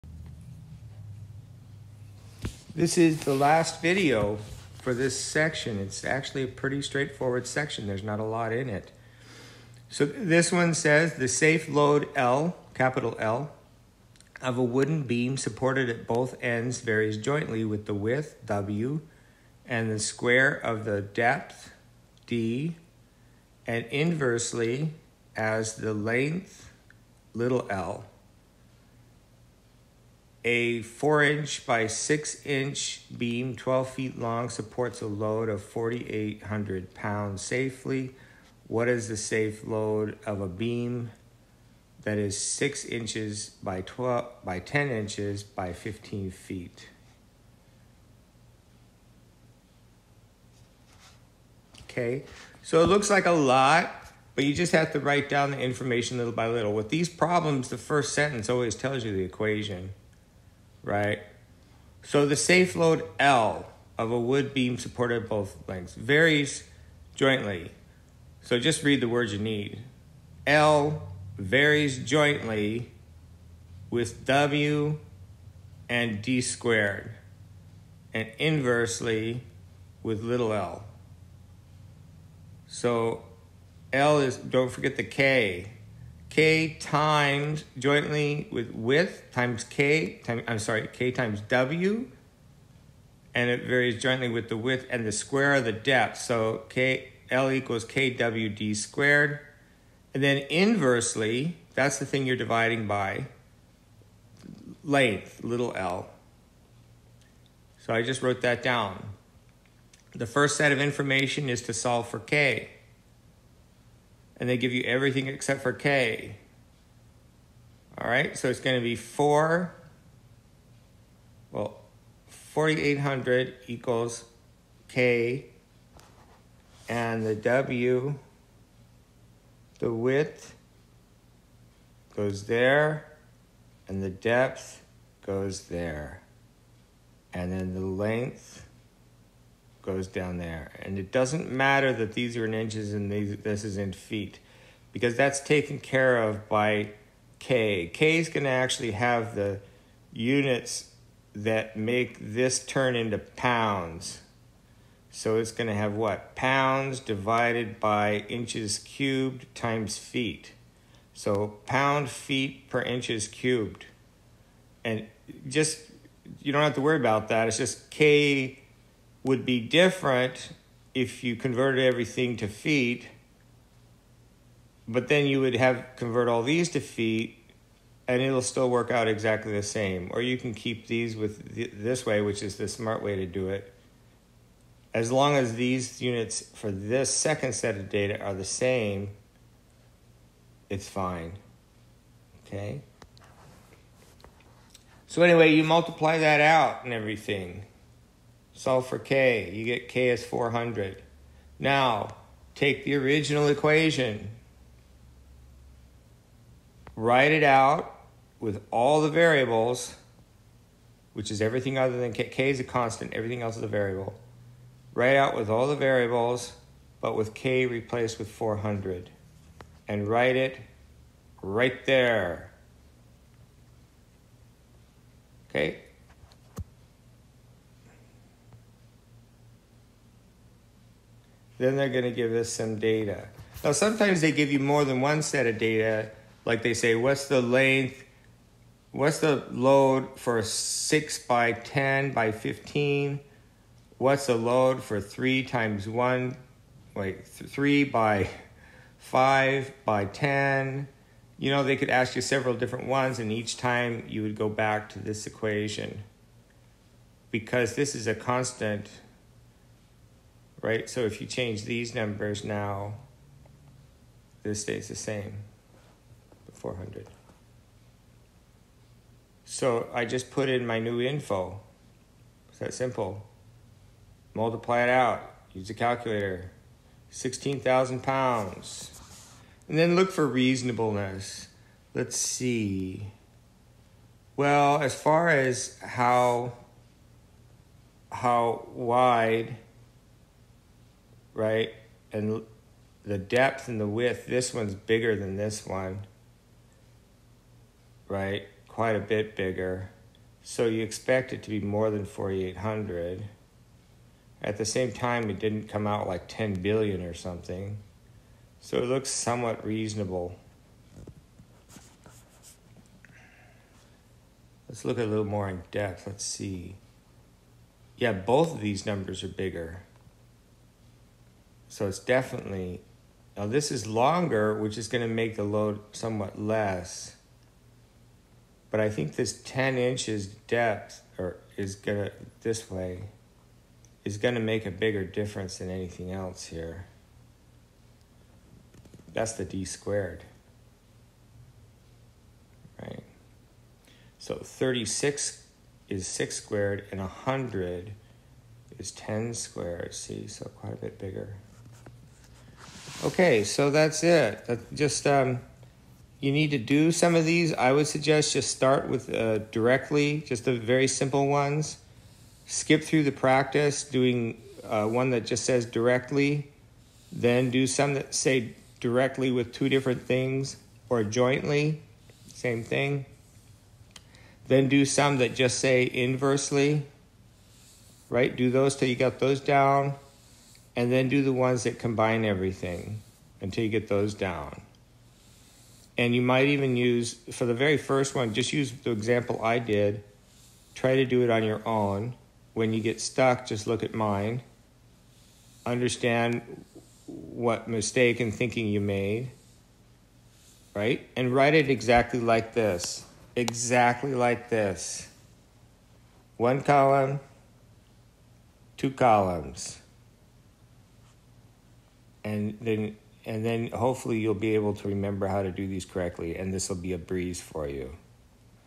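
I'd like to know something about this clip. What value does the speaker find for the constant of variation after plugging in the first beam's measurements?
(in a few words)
400.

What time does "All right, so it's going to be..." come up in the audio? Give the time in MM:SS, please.
01:57.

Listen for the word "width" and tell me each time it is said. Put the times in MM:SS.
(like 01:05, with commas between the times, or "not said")
00:17, 01:28, 01:34, 02:09, 04:53.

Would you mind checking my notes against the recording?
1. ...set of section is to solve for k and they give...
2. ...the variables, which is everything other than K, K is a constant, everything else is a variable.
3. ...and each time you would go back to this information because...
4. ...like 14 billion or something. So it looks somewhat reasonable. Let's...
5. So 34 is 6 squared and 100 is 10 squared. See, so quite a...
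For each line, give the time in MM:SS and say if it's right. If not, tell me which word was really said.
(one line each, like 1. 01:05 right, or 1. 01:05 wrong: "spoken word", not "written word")
1. 01:50 wrong: "information", not "section"
2. 03:29 right
3. 04:13 wrong: "equation", not "information"
4. 05:06 wrong: "10", not "14"
5. 05:44 wrong: "36", not "34".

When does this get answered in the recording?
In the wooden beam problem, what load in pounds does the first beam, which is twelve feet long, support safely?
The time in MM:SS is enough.
00:35.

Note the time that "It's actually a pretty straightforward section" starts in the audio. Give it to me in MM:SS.
00:05.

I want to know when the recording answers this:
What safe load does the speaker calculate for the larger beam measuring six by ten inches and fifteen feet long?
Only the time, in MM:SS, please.
04:37.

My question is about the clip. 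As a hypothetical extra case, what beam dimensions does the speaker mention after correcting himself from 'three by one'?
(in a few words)
3 by 5 by 10.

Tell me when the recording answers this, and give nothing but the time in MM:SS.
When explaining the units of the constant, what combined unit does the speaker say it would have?
02:41.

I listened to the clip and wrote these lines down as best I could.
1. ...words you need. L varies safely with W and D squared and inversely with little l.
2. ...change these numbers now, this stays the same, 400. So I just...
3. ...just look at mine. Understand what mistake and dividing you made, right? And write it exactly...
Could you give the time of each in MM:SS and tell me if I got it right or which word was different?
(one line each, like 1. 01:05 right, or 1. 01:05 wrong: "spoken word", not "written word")
1. 01:09 wrong: "jointly", not "safely"
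2. 04:21 right
3. 06:33 wrong: "thinking", not "dividing".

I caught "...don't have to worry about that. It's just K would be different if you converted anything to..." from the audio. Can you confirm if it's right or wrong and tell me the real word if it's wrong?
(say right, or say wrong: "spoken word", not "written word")
wrong: "everything", not "anything".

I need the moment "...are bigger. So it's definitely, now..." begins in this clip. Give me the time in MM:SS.
05:19.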